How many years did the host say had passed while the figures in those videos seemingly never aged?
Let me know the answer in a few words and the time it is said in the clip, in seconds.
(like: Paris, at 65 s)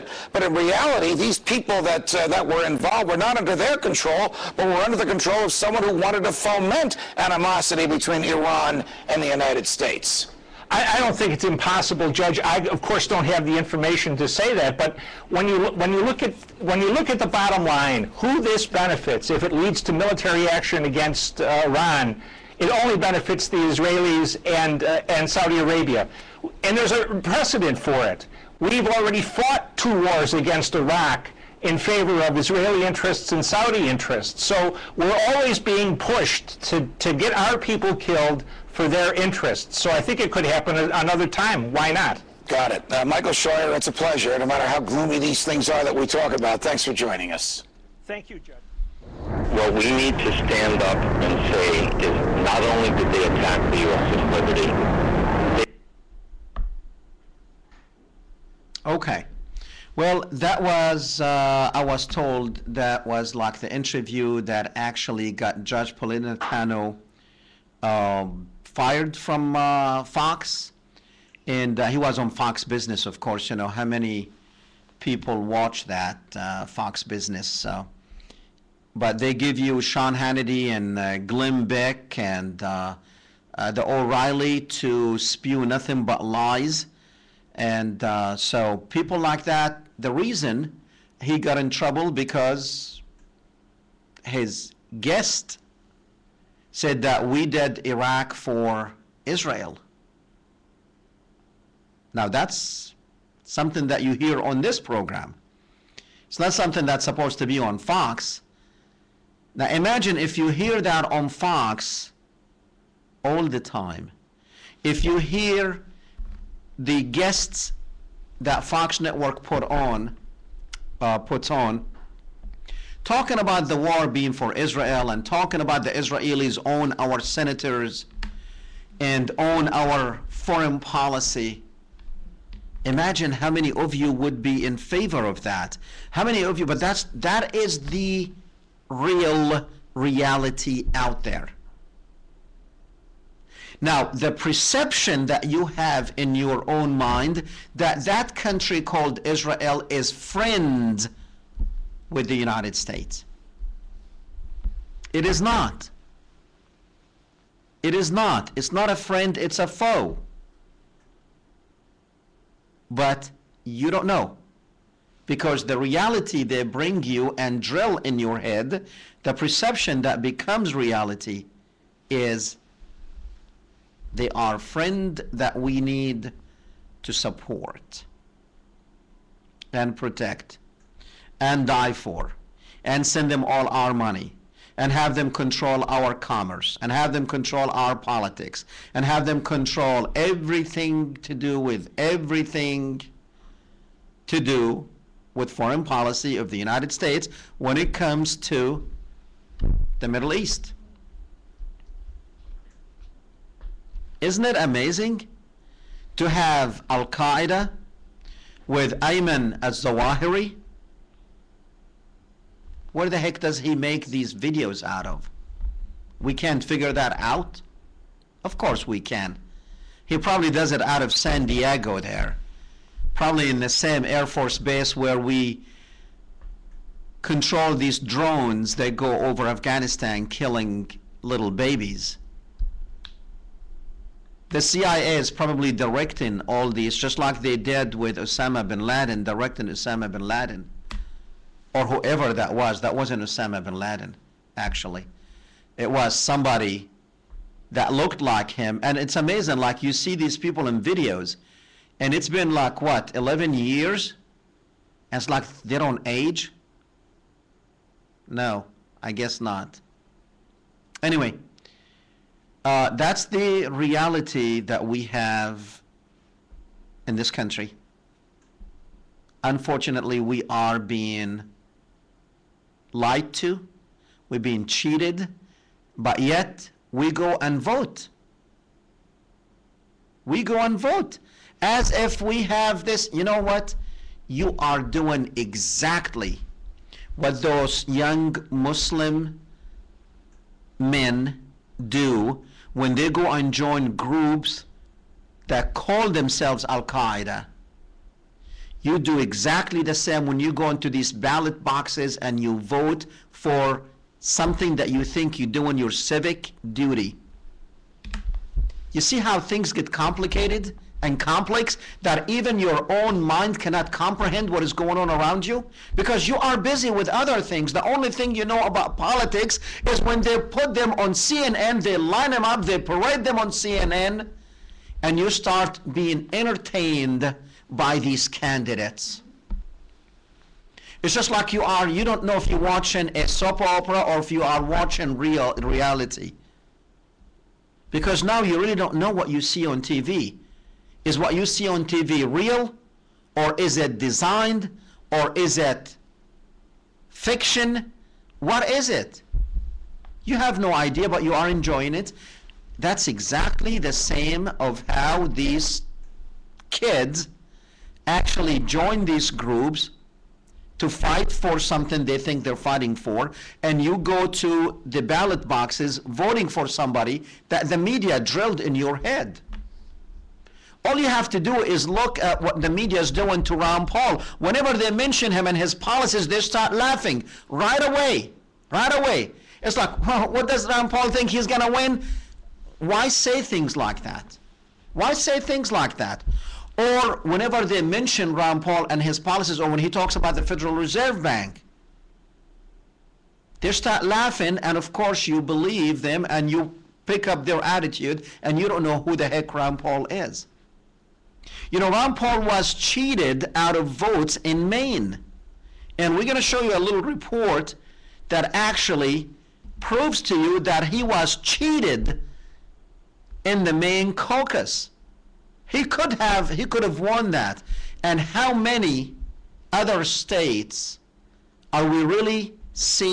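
11, at 253 s.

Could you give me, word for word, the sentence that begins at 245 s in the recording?
It was somebody that looked like him.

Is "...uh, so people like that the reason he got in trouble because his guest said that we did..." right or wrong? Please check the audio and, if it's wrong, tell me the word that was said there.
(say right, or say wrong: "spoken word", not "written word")
right.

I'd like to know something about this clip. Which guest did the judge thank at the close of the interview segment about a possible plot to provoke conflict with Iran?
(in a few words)
Michael Scheuer.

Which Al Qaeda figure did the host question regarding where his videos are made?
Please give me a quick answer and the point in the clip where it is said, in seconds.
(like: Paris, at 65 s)
Ayman al Zawahiri, at 208 s.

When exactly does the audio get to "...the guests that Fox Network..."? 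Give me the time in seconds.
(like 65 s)
116 s.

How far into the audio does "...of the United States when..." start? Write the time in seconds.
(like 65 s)
196 s.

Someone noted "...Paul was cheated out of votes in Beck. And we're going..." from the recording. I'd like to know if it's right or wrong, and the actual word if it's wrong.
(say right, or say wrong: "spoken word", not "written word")
wrong: "Maine", not "Beck".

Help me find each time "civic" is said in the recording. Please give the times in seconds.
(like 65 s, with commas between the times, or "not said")
305 s.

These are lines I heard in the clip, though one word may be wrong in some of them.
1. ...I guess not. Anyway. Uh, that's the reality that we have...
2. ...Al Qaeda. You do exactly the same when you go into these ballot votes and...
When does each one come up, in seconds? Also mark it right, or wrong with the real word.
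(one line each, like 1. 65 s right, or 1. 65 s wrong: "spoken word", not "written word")
1. 259 s right
2. 296 s wrong: "boxes", not "votes".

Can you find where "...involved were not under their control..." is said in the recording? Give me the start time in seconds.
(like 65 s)
2 s.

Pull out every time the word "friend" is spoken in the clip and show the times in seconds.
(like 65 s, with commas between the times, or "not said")
150 s, 158 s, 174 s.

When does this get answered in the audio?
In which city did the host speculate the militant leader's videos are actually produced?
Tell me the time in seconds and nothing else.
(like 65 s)
221 s.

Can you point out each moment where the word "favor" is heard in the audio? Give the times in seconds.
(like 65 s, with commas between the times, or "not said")
31 s, 134 s.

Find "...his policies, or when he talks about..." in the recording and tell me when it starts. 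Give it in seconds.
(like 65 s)
389 s.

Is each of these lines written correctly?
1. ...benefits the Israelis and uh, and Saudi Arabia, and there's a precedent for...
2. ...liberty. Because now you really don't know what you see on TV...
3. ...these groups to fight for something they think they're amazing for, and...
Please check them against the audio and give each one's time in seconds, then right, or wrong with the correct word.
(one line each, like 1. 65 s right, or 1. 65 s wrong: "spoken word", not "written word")
1. 22 s right
2. 335 s wrong: "reality", not "liberty"
3. 359 s wrong: "fighting", not "amazing".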